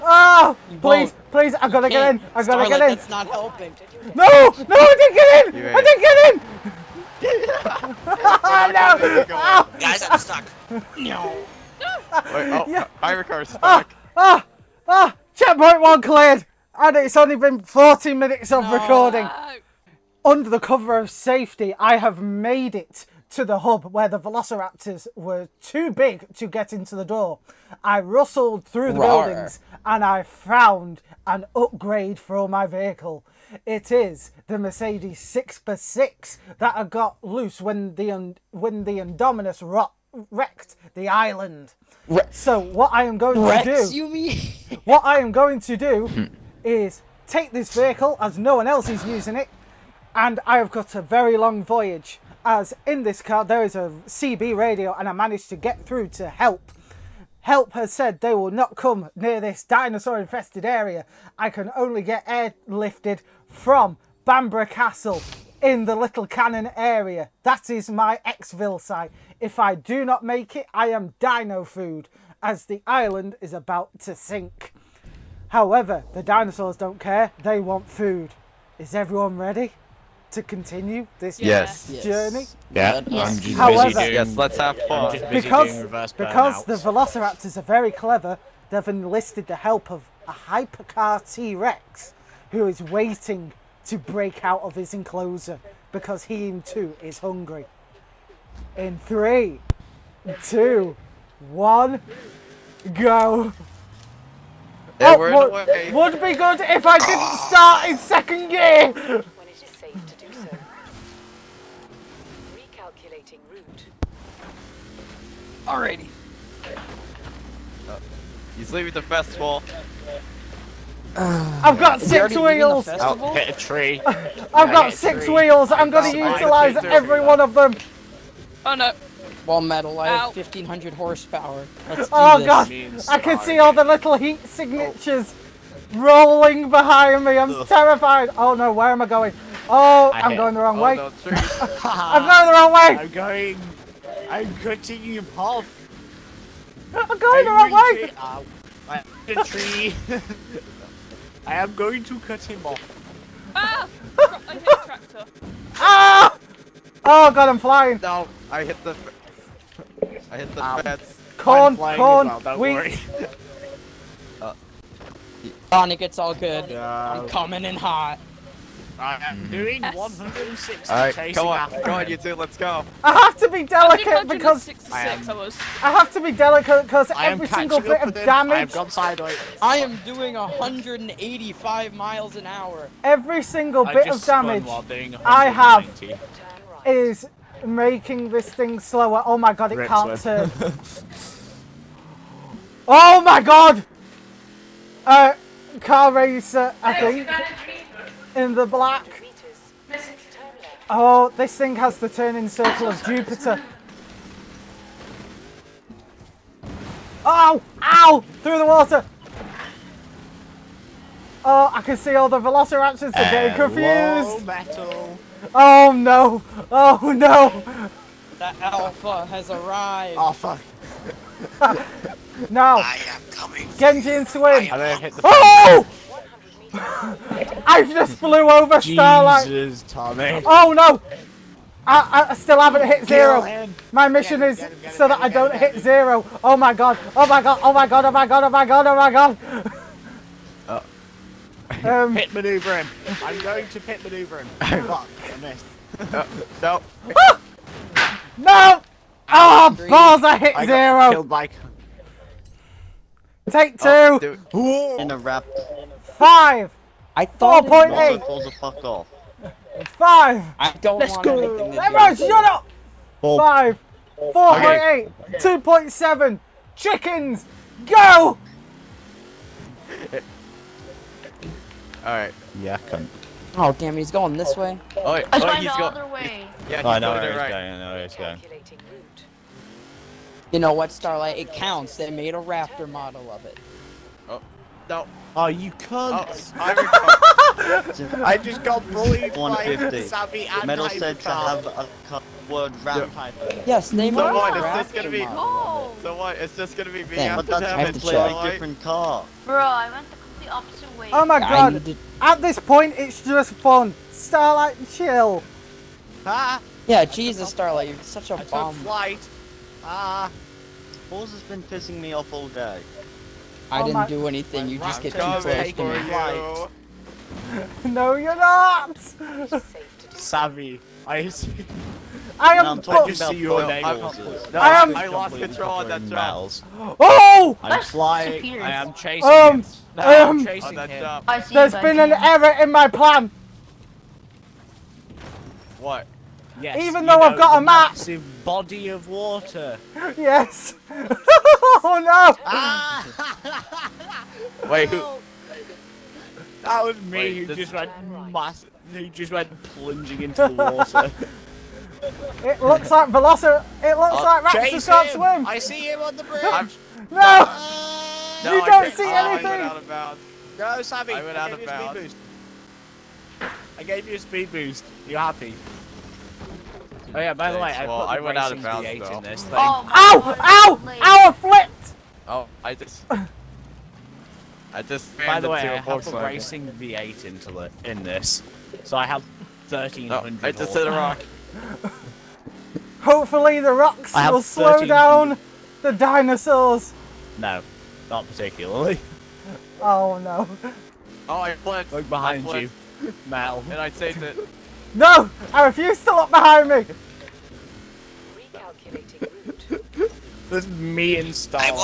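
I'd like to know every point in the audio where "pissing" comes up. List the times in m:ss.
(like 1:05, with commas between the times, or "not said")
5:11.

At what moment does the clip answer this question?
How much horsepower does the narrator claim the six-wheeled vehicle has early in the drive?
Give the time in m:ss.
2:10.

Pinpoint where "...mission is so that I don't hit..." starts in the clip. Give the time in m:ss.
3:54.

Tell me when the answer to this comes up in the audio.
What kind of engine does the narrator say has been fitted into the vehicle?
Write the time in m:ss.
6:16.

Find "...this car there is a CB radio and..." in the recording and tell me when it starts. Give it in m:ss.
0:53.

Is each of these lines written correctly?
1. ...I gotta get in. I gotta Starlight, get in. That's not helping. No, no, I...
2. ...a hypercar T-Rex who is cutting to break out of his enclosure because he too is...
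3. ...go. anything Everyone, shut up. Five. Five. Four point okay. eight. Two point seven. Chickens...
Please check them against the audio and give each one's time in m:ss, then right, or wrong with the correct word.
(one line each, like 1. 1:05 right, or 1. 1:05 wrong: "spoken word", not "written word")
1. 0:01 right
2. 1:30 wrong: "waiting", not "cutting"
3. 4:21 wrong: "Four", not "Five".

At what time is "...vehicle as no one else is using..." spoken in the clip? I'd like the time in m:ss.
0:47.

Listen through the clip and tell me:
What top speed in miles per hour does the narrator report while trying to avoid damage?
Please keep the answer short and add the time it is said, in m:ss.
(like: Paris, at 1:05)
185, at 3:00.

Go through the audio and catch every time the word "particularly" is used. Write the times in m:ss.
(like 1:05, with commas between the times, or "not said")
6:28.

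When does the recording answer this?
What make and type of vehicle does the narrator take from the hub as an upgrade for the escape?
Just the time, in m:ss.
0:34.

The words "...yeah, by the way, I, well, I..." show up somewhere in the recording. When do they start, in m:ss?
6:07.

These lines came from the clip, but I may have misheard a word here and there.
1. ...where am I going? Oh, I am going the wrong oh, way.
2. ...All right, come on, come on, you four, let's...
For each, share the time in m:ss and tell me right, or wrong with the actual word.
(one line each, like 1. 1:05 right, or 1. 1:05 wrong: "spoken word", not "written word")
1. 2:18 right
2. 2:50 wrong: "two", not "four".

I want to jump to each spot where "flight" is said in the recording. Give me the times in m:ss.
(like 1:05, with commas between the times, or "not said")
5:08.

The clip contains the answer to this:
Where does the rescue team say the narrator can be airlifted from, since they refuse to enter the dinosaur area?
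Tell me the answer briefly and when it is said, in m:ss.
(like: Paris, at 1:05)
Bamborough Castle, at 1:04.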